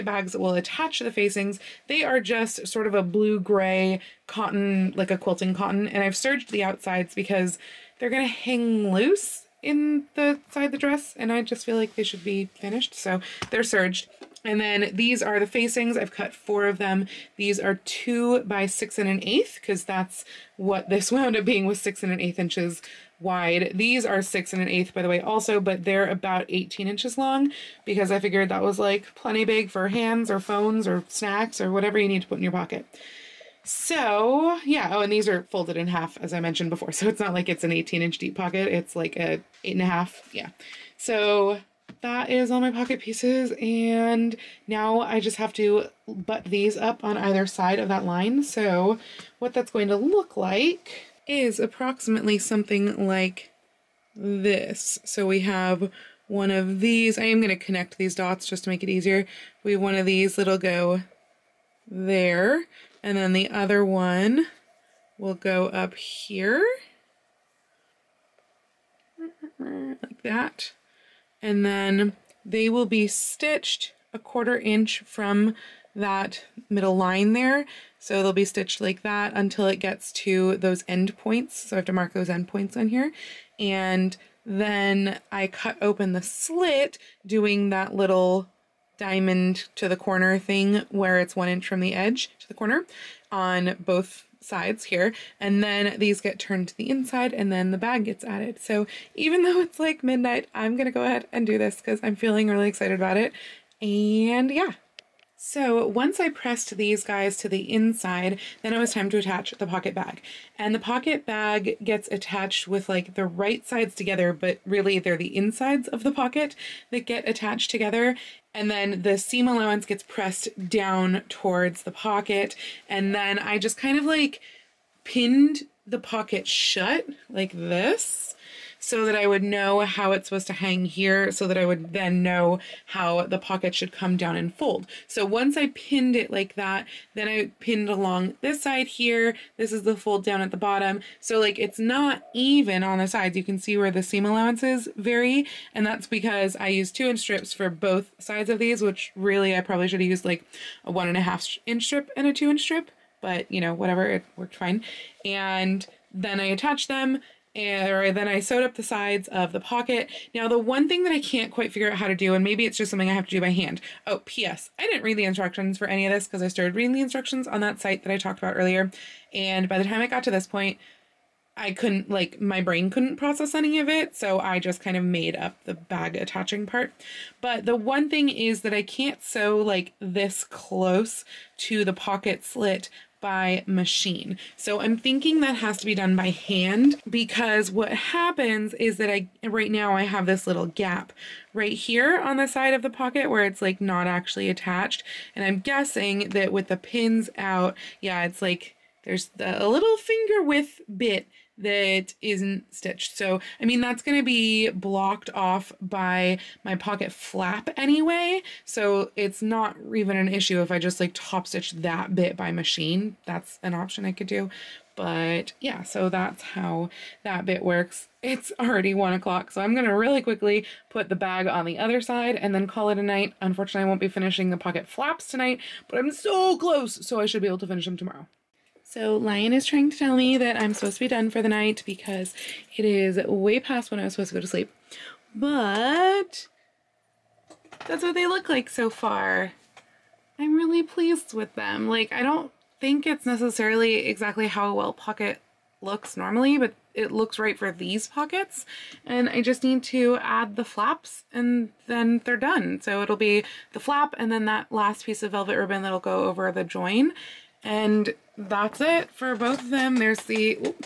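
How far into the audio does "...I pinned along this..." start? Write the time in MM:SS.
02:17.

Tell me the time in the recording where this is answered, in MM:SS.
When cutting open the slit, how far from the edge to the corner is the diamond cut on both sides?
01:31.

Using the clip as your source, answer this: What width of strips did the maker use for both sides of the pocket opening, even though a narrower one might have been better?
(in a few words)
2 inch.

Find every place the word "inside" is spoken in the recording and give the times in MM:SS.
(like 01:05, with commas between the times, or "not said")
01:36, 01:47, 01:55.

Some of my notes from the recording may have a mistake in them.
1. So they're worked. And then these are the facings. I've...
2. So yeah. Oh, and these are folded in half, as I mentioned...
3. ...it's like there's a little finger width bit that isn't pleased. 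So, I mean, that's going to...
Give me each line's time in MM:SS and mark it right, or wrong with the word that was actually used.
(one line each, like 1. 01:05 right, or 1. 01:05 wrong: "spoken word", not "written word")
1. 00:12 wrong: "serged", not "worked"
2. 00:33 right
3. 03:18 wrong: "stitched", not "pleased".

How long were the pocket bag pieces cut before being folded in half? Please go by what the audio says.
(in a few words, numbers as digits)
18 inches.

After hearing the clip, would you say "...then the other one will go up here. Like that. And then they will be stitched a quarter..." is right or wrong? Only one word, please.
right.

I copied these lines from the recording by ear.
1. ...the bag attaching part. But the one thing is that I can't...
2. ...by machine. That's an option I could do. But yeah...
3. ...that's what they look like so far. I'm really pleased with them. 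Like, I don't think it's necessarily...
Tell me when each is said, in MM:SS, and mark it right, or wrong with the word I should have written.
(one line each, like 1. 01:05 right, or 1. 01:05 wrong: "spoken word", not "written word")
1. 02:55 right
2. 03:32 right
3. 03:57 right.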